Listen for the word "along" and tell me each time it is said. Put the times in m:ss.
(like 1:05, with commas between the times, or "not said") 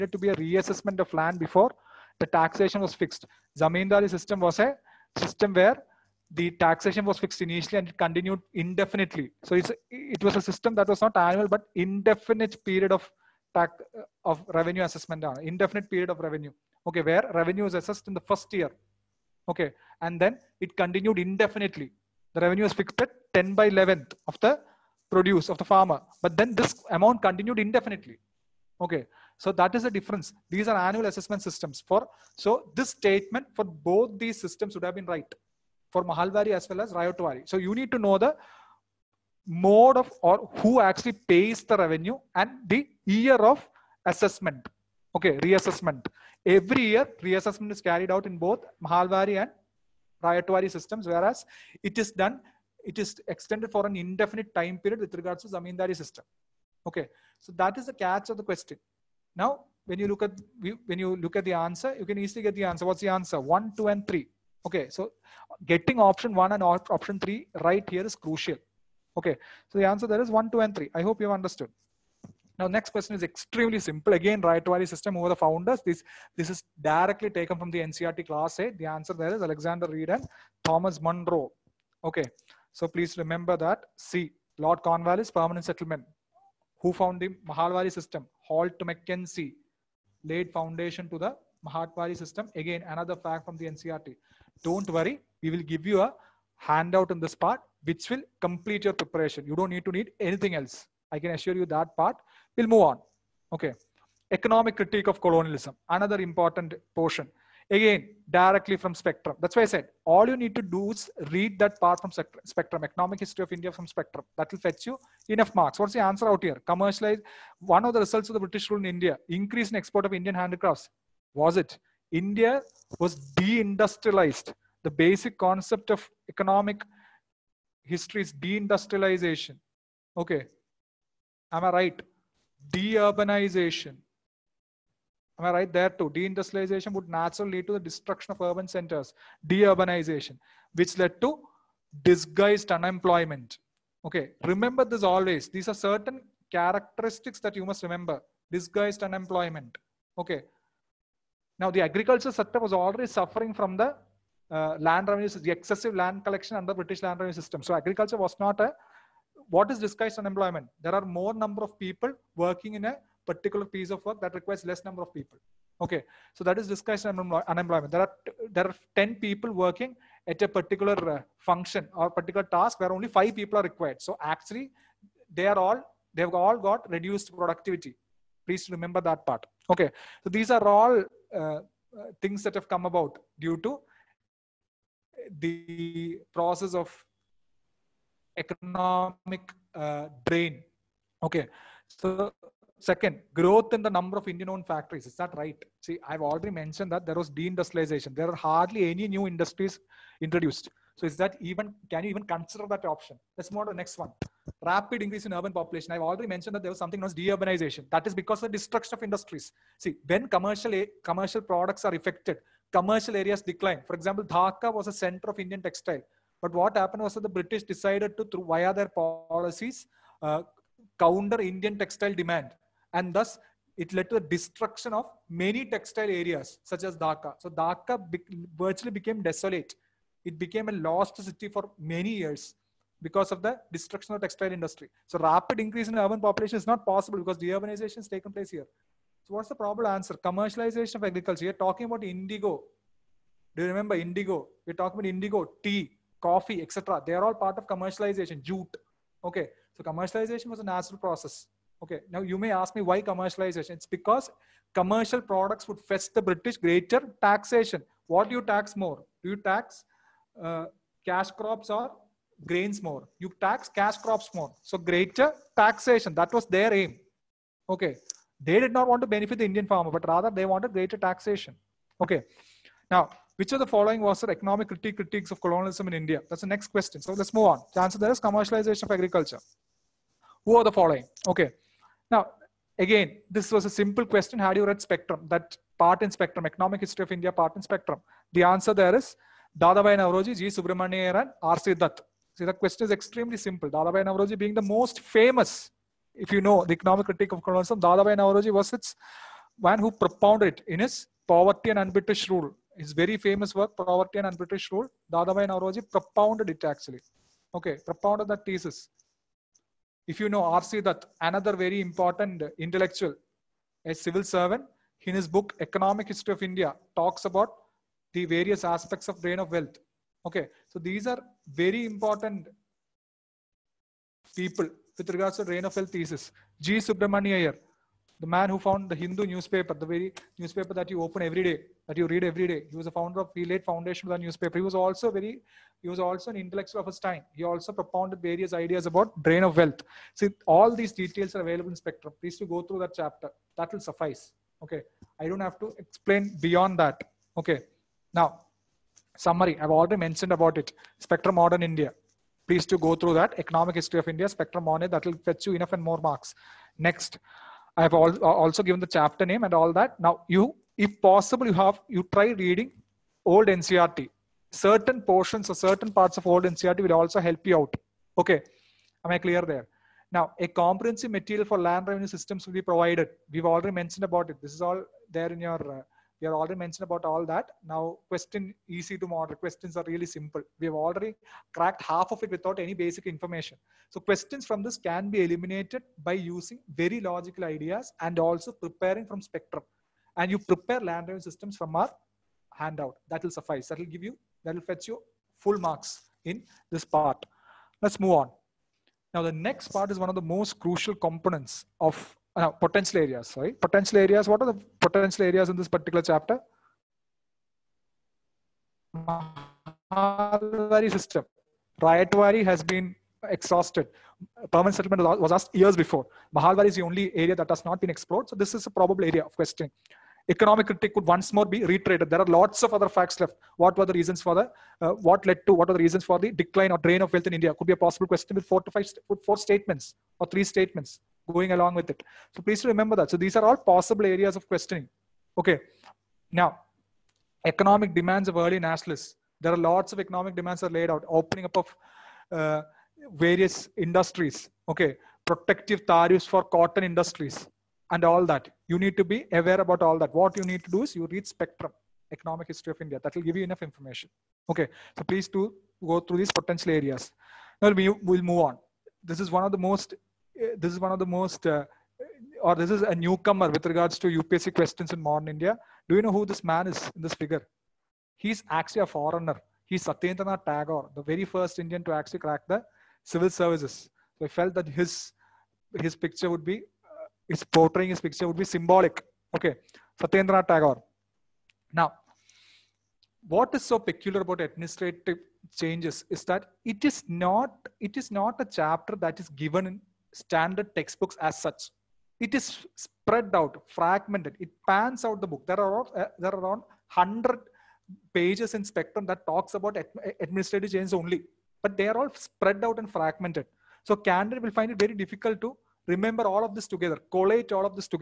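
7:11.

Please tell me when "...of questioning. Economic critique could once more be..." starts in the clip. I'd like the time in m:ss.
6:59.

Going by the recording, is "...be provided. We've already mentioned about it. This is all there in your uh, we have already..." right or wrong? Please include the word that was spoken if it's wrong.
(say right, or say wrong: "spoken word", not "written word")
right.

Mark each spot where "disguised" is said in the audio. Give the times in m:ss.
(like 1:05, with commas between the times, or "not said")
2:22, 2:28, 2:39.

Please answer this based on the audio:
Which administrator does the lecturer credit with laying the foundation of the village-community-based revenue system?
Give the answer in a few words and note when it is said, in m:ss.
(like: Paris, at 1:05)
Holt Mackenzie, at 1:28.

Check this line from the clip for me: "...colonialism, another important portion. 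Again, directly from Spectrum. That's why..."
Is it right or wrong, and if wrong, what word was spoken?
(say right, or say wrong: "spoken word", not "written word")
right.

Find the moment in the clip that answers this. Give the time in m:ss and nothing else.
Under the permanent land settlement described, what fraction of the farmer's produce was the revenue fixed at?
0:23.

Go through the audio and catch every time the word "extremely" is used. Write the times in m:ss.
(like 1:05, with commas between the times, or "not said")
1:13, 4:52.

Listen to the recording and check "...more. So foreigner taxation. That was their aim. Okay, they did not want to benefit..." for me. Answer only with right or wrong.
wrong.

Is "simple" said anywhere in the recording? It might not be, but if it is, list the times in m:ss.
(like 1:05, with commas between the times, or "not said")
1:13, 4:43, 4:53, 6:20.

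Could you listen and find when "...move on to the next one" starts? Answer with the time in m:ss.
3:23.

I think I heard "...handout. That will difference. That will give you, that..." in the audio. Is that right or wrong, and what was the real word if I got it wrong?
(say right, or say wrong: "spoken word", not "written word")
wrong: "suffice", not "difference".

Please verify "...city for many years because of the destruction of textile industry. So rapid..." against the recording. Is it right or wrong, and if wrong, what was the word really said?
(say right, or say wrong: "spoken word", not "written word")
right.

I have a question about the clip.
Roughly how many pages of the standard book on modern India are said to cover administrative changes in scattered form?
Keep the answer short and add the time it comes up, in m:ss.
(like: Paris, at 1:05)
100, at 8:16.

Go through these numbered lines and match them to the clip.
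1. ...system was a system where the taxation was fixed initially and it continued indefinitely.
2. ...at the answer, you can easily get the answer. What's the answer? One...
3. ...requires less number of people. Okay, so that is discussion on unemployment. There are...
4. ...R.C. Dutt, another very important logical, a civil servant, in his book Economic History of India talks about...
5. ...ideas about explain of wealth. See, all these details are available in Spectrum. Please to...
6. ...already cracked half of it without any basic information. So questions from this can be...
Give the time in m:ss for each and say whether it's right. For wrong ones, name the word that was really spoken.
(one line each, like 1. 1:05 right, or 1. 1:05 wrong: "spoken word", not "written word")
1. 0:04 right
2. 1:01 right
3. 2:44 right
4. 5:10 wrong: "intellectual", not "logical"
5. 5:38 wrong: "drain", not "explain"
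6. 6:20 right.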